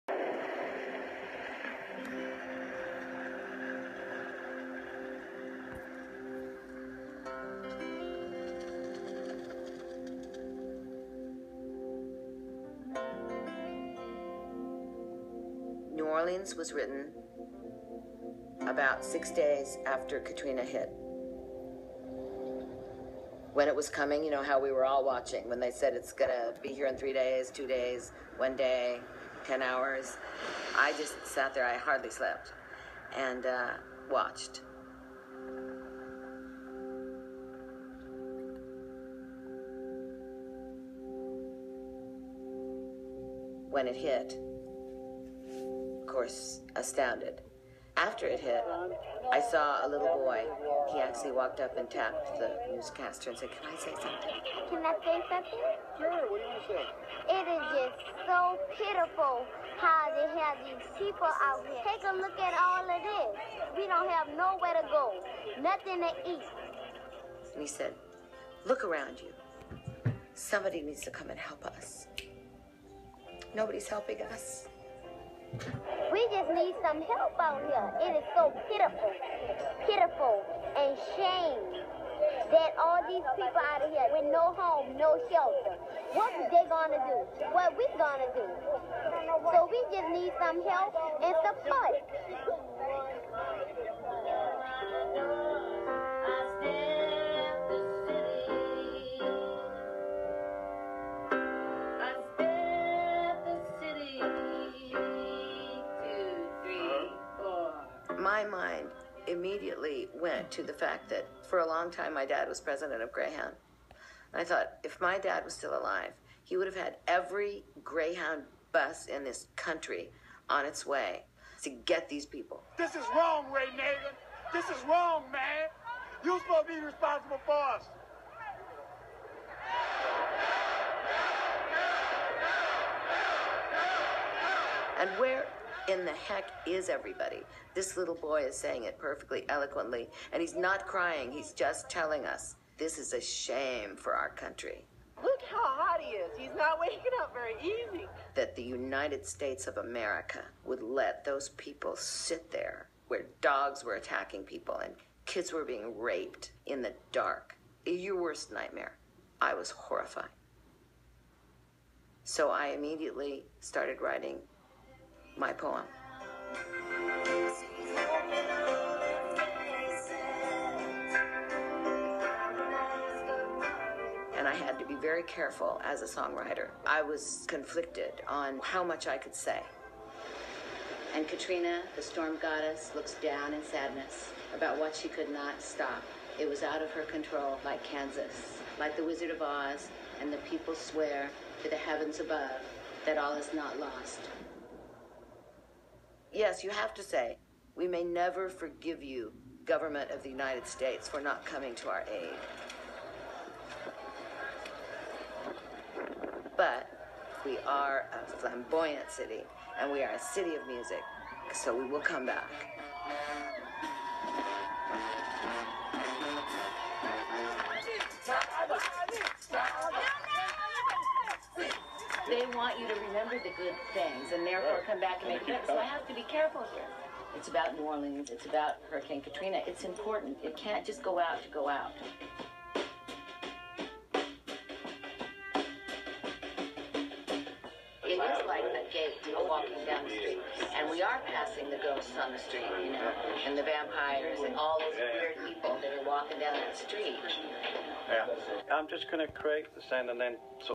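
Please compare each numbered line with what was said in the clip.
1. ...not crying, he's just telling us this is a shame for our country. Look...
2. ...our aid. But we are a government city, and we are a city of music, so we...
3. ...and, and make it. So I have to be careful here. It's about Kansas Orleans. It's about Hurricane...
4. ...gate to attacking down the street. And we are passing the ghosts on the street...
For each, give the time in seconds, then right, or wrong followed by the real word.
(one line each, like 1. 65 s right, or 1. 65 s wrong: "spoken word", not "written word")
1. 140 s right
2. 201 s wrong: "flamboyant", not "government"
3. 225 s wrong: "New", not "Kansas"
4. 238 s wrong: "walking", not "attacking".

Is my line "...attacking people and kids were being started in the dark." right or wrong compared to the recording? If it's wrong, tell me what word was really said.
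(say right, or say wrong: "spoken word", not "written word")
wrong: "raped", not "started".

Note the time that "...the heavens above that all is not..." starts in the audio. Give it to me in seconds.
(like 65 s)
191 s.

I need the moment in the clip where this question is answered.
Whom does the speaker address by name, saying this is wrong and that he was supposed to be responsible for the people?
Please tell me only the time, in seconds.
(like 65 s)
123 s.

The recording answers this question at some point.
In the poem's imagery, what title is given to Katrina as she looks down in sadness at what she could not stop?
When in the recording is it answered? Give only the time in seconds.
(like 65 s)
181 s.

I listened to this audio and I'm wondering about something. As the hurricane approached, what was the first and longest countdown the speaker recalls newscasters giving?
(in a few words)
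3 days.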